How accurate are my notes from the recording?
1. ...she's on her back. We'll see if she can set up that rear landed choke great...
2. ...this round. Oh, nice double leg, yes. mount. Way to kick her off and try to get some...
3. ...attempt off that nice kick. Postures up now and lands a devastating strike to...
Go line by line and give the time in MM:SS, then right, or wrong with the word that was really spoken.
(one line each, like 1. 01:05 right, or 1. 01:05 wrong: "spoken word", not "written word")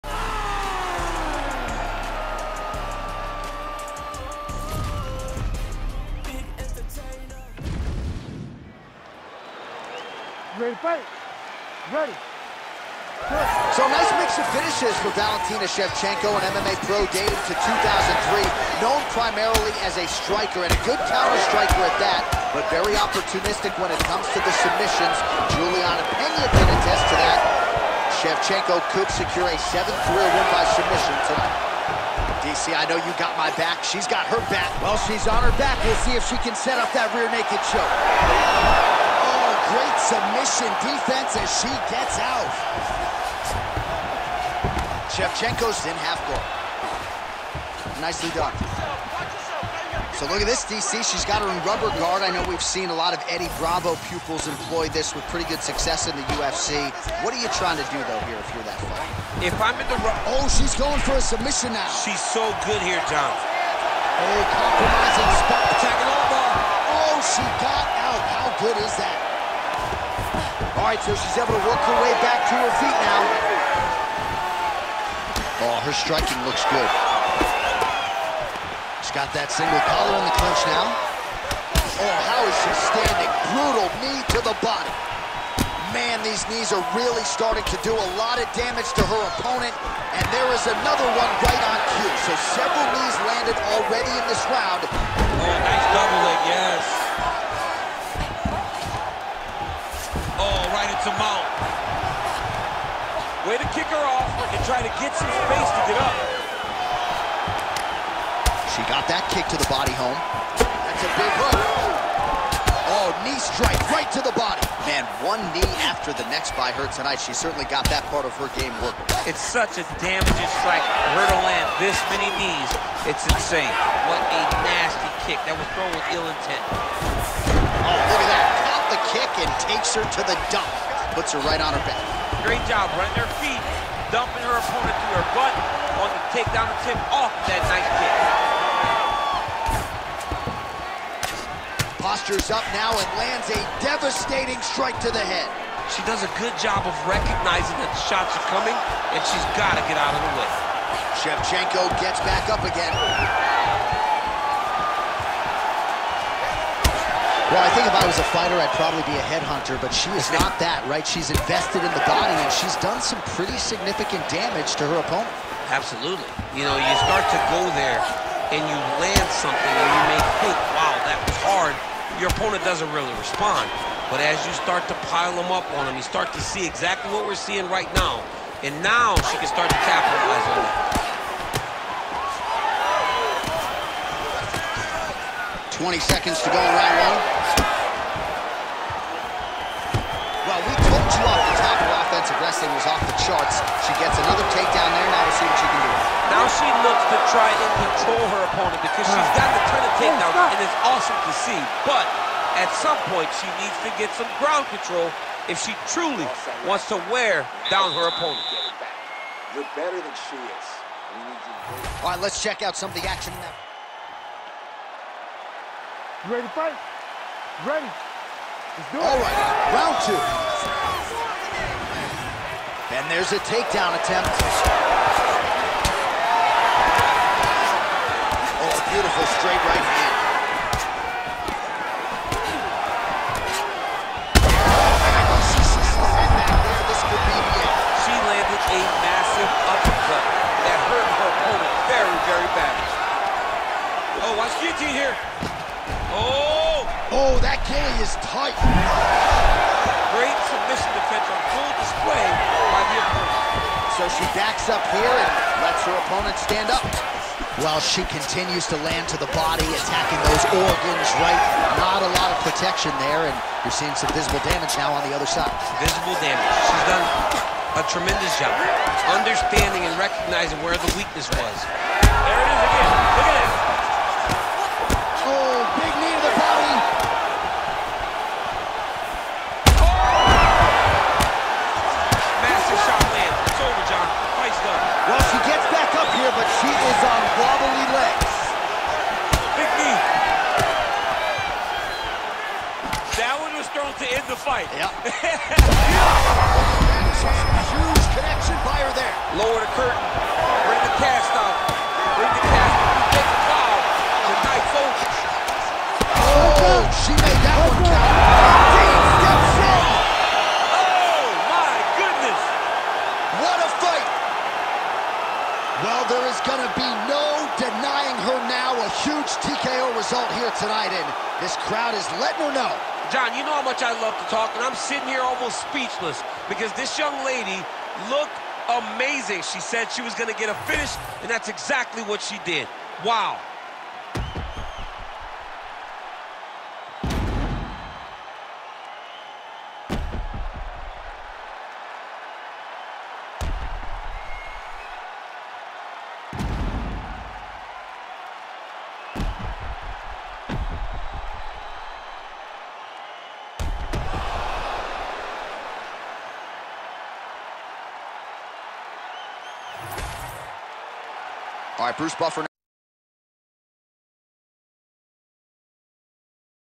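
1. 00:35 wrong: "naked", not "landed"
2. 01:34 right
3. 02:16 right.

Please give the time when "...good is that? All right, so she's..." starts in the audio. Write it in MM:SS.
01:08.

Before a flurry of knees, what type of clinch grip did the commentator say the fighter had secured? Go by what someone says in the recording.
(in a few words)
single collar.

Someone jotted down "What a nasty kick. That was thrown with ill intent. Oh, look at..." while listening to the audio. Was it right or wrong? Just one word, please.
right.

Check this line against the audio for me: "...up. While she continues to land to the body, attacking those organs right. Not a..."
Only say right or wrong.
right.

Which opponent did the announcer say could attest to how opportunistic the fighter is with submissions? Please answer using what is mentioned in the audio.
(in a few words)
Juliana Pena.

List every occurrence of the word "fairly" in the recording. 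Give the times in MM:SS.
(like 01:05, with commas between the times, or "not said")
not said.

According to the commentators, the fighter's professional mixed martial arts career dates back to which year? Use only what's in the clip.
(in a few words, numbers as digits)
2003.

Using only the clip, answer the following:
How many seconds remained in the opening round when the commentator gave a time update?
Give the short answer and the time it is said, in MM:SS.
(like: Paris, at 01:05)
20, at 03:05.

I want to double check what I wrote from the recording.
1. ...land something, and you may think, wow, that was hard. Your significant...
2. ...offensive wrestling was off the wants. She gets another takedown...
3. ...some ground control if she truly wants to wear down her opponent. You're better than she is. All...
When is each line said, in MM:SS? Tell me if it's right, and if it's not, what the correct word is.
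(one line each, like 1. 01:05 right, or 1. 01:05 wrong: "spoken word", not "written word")
1. 02:49 wrong: "opponent", not "significant"
2. 03:12 wrong: "charts", not "wants"
3. 03:24 right.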